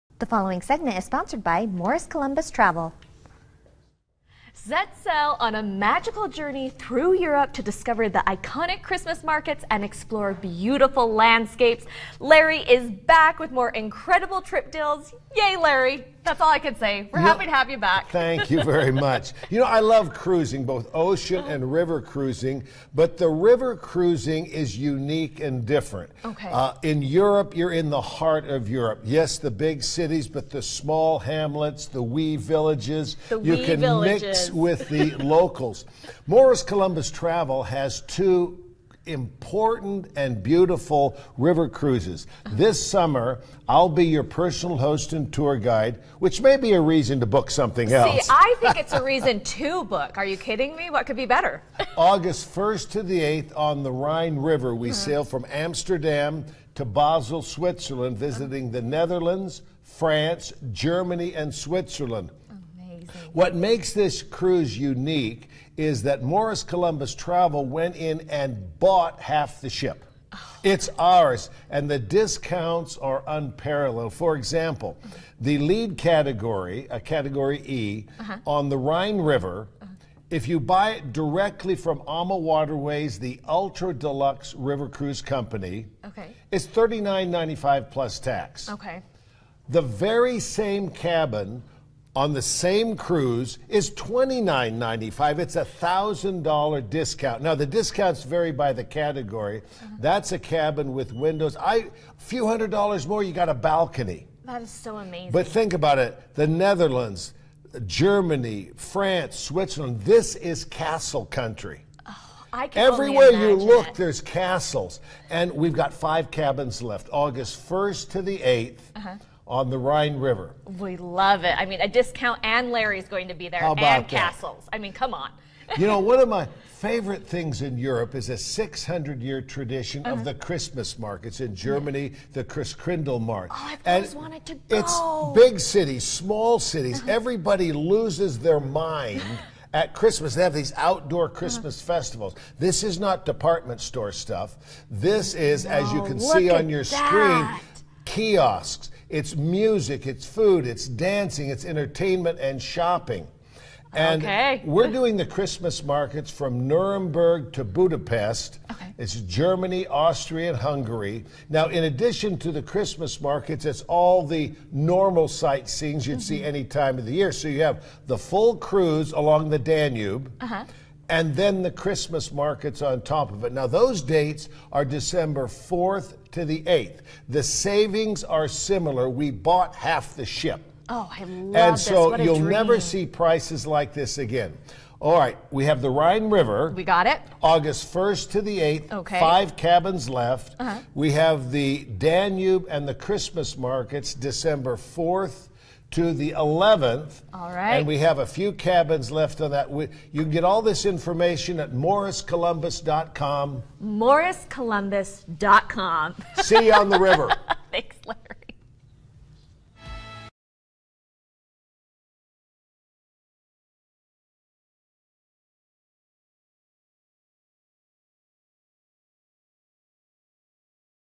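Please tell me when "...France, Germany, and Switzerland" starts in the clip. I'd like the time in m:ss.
0:59.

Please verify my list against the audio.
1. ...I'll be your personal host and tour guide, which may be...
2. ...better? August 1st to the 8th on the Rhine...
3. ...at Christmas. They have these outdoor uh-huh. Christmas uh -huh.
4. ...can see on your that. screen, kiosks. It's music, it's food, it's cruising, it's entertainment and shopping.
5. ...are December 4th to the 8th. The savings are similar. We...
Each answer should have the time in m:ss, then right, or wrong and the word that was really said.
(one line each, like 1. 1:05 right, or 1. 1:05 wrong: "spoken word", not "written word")
1. 0:43 right
2. 0:51 right
3. 2:19 right
4. 2:26 wrong: "dancing", not "cruising"
5. 2:54 right.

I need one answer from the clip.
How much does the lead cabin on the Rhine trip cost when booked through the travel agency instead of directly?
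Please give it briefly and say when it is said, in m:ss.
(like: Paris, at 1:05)
$29.95, at 1:33.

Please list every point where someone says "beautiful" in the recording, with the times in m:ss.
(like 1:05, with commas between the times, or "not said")
0:10, 0:40.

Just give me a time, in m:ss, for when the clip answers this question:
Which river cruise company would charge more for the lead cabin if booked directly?
1:22.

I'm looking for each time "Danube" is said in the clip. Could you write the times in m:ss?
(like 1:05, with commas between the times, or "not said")
2:49, 3:11.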